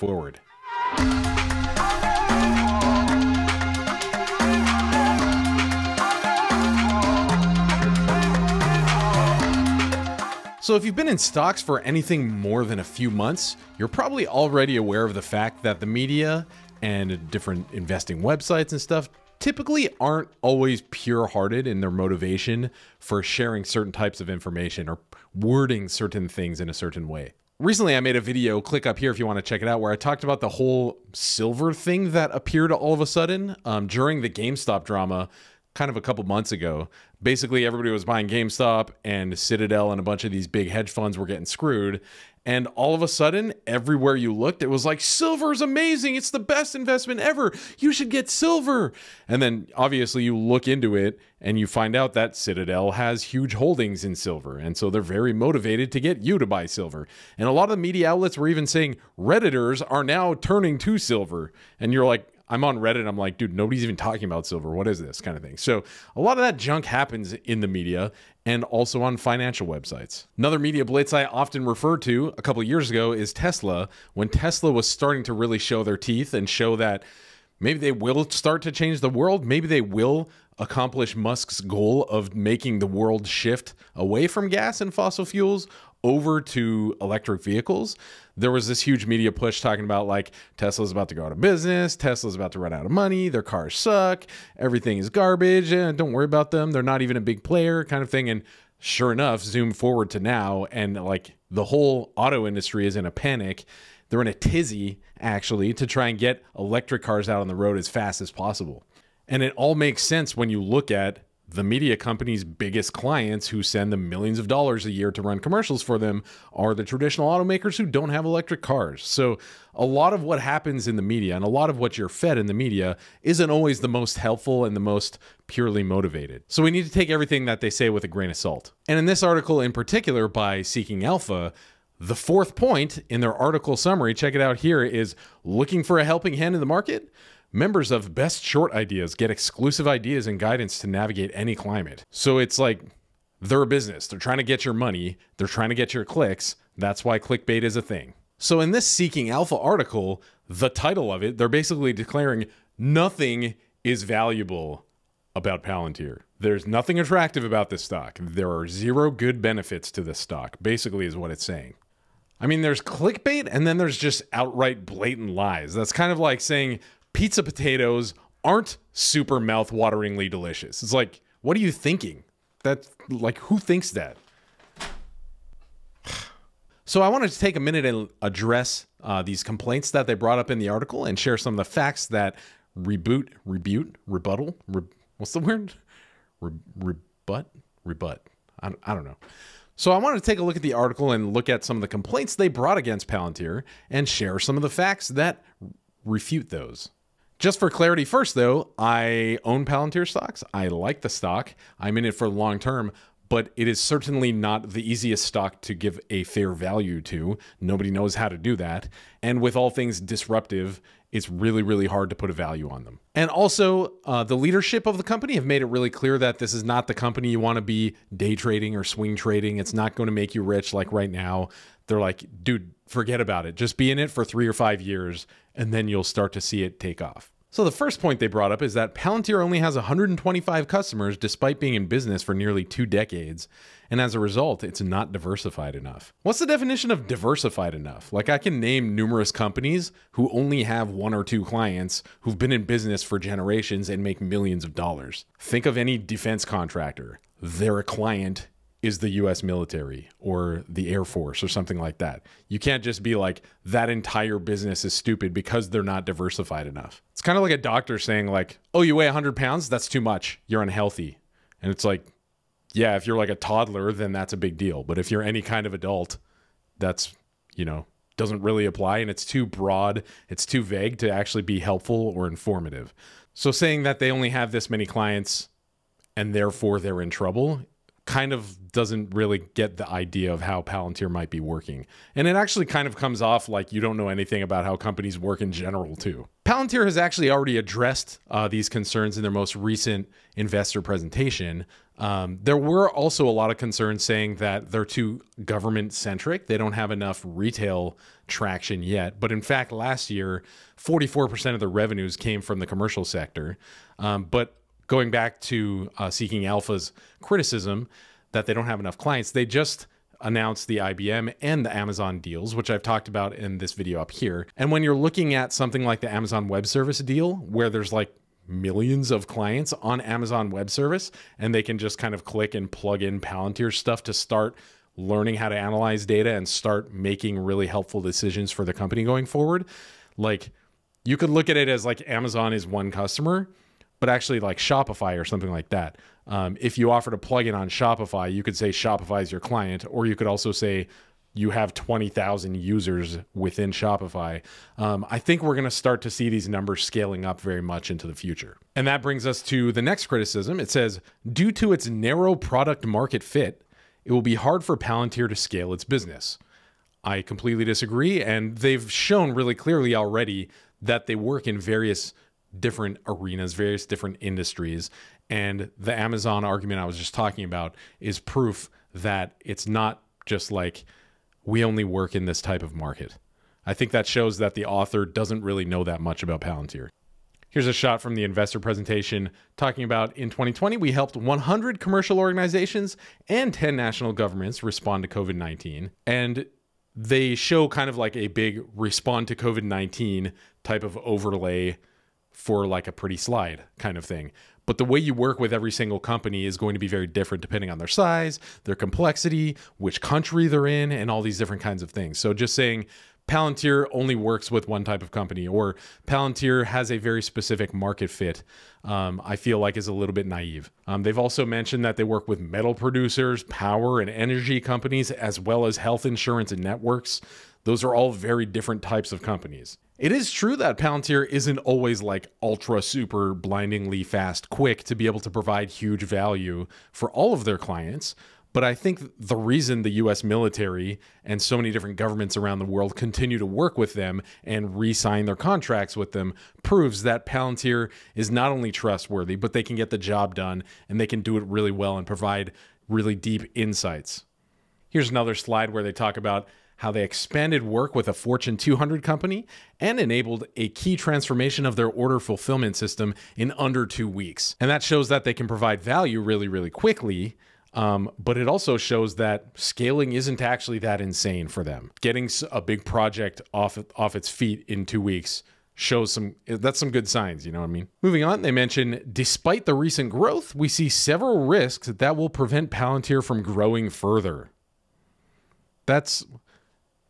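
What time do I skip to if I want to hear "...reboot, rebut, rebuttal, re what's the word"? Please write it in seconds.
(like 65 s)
182 s.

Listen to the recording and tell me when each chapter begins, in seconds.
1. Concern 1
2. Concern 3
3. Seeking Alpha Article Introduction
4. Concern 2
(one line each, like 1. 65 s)
1. 227 s
2. 467 s
3. 134 s
4. 349 s.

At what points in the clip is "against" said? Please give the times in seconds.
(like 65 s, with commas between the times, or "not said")
192 s.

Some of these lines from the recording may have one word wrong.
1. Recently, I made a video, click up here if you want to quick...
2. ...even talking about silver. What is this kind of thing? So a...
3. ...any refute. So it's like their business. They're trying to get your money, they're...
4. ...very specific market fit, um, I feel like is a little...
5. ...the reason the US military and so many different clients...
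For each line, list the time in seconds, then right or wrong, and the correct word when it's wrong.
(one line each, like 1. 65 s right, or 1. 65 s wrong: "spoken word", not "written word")
1. 27 s wrong: "check", not "quick"
2. 63 s right
3. 141 s wrong: "climate", not "refute"
4. 406 s right
5. 429 s wrong: "governments", not "clients".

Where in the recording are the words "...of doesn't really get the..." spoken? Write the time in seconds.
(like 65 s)
278 s.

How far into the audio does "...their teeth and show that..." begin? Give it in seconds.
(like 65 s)
75 s.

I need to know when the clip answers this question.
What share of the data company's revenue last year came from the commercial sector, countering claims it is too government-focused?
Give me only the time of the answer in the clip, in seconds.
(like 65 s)
300 s.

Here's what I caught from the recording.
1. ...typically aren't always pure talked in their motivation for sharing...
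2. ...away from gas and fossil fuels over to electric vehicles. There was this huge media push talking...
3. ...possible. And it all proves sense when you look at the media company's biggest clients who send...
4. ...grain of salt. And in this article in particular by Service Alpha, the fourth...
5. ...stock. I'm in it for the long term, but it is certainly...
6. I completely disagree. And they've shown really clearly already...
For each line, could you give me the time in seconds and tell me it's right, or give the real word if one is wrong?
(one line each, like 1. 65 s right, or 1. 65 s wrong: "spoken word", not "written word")
1. 19 s wrong: "hearted", not "talked"
2. 83 s right
3. 108 s wrong: "makes", not "proves"
4. 128 s wrong: "Seeking", not "Service"
5. 201 s right
6. 357 s right.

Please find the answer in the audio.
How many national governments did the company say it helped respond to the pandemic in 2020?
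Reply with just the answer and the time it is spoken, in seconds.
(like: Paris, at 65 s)
10, at 383 s.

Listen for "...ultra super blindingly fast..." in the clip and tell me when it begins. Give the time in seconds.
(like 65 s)
422 s.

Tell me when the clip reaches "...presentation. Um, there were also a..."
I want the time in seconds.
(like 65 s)
290 s.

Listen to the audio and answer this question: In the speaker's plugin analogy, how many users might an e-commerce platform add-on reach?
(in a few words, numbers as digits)
20,000.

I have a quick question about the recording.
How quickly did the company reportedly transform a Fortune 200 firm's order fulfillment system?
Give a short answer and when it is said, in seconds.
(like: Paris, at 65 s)
under two weeks, at 453 s.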